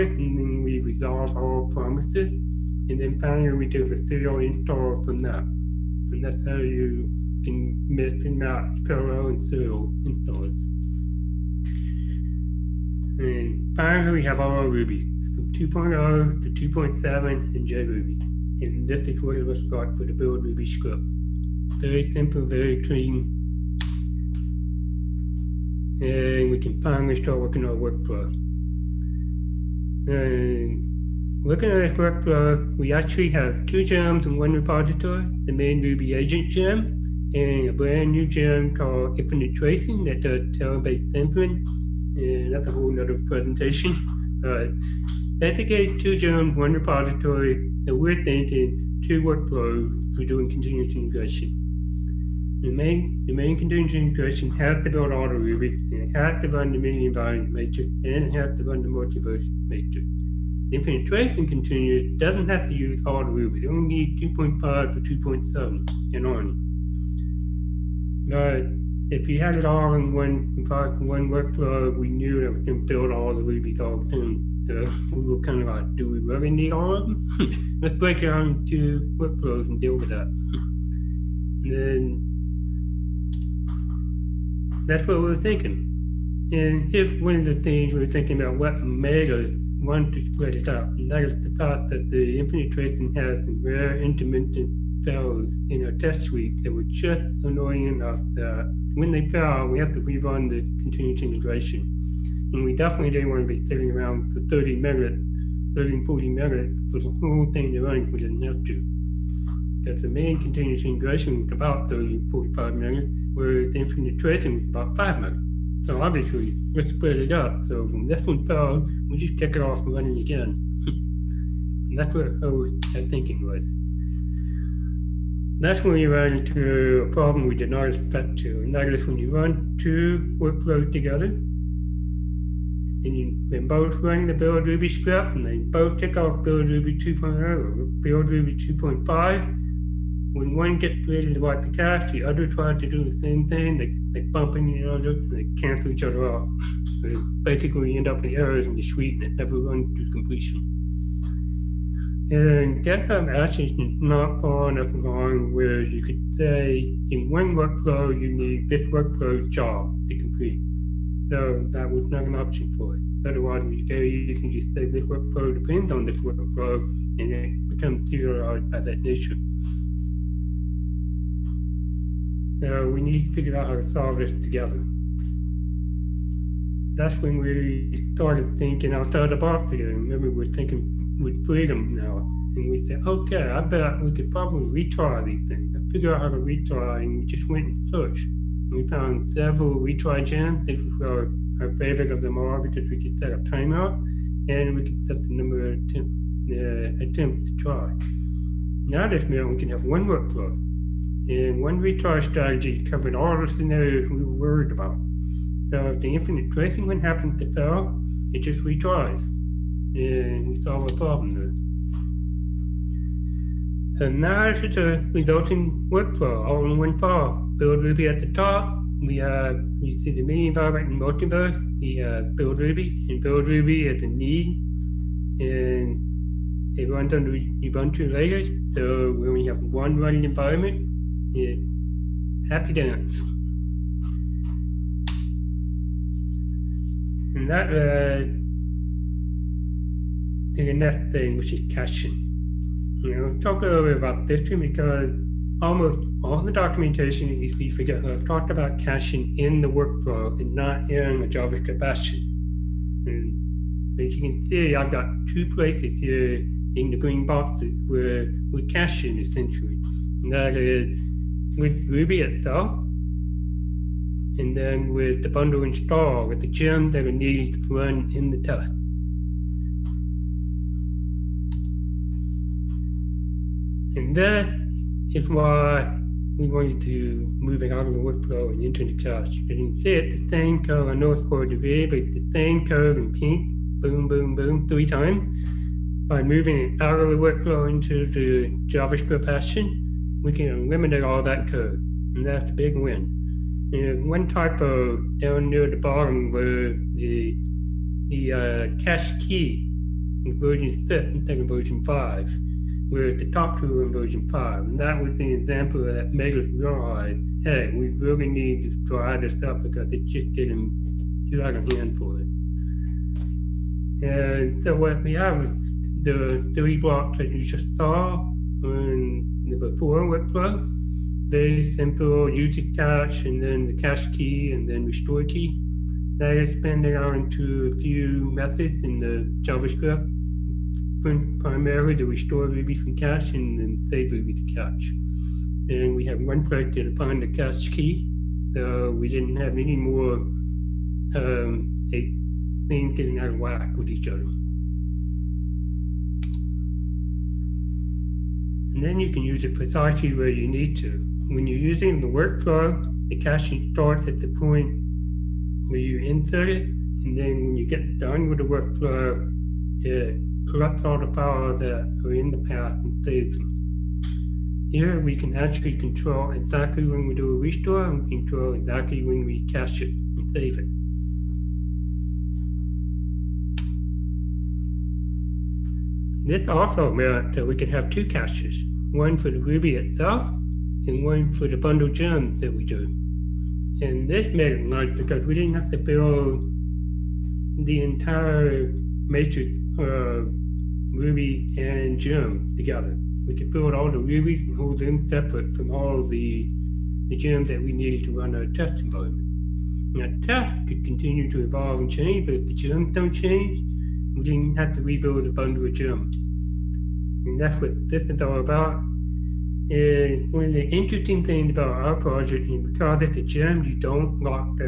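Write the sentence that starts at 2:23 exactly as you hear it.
They, they bump into each other and they cancel each other out.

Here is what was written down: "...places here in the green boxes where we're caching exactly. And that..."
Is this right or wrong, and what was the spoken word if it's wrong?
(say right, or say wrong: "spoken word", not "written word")
wrong: "essentially", not "exactly".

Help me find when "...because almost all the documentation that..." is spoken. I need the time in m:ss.
4:04.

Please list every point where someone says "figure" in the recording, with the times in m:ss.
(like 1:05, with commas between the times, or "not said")
2:53, 3:05.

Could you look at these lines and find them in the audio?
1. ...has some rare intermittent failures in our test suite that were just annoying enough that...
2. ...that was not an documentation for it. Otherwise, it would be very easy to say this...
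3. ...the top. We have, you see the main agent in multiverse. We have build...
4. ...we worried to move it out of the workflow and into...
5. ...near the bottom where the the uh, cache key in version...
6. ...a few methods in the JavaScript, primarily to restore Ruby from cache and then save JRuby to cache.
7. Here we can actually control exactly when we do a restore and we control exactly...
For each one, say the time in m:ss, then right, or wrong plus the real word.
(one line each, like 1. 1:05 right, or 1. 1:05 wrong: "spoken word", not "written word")
1. 1:33 right
2. 2:41 wrong: "option", not "documentation"
3. 3:38 wrong: "environment", not "agent"
4. 4:36 wrong: "wanted", not "worried"
5. 4:55 right
6. 5:27 wrong: "Ruby", not "JRuby"
7. 6:04 right.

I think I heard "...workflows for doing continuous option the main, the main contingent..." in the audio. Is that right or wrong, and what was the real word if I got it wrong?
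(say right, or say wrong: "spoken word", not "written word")
wrong: "integration", not "option".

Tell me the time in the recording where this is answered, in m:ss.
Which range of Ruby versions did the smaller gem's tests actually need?
1:04.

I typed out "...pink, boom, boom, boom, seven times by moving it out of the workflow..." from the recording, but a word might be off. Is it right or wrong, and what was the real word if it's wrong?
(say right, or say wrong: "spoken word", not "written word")
wrong: "three", not "seven".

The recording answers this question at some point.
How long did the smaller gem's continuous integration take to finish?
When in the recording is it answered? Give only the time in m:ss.
1:54.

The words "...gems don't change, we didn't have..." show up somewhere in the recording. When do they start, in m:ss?
6:42.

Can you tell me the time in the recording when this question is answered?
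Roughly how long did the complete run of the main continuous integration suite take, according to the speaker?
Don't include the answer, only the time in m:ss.
1:51.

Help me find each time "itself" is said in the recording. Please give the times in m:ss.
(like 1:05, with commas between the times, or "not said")
4:22, 6:19.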